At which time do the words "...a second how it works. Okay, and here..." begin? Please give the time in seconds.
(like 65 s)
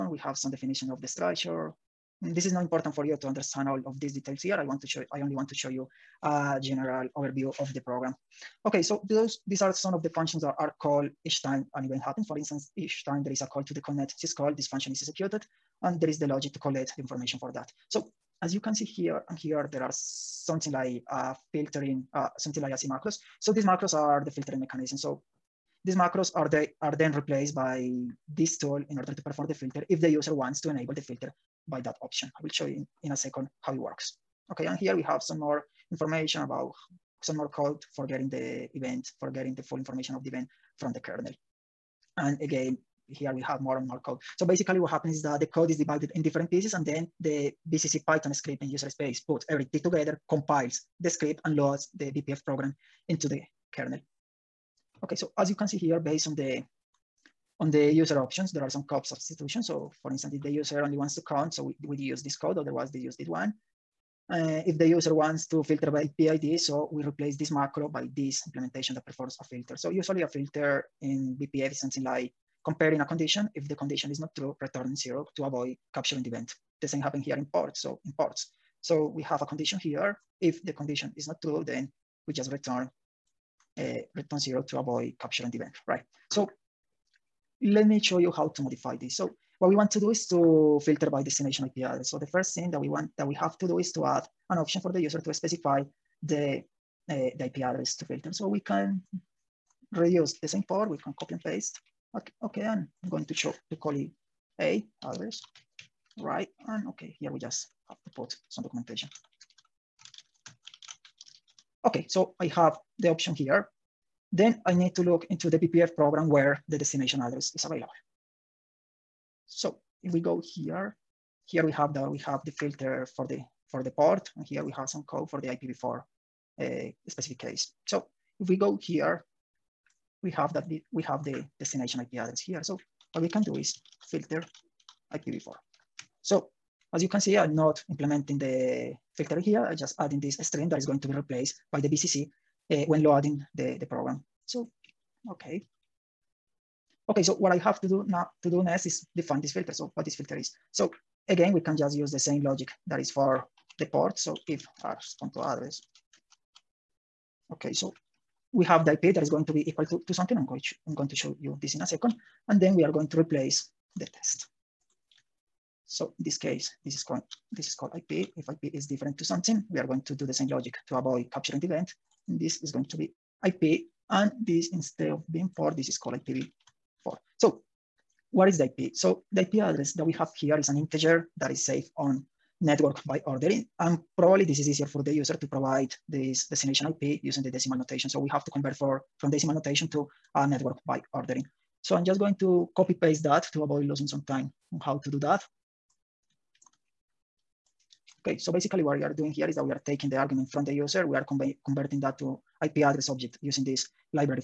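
33 s.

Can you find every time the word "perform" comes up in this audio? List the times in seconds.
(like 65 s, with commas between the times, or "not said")
29 s, 69 s.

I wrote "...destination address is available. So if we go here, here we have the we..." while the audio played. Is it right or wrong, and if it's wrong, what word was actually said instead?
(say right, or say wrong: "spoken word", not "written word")
right.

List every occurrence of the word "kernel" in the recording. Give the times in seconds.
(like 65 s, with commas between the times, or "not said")
40 s, 53 s.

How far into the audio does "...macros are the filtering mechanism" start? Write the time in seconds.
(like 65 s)
23 s.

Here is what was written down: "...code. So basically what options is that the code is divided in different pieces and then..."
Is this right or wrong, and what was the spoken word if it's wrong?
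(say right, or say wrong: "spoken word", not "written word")
wrong: "happens", not "options".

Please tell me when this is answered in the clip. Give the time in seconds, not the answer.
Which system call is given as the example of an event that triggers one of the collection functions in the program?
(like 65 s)
13 s.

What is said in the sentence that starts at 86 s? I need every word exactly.
So let me show you how to modify this.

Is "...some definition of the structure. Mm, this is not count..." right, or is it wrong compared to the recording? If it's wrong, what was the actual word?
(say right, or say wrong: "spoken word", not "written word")
wrong: "important", not "count".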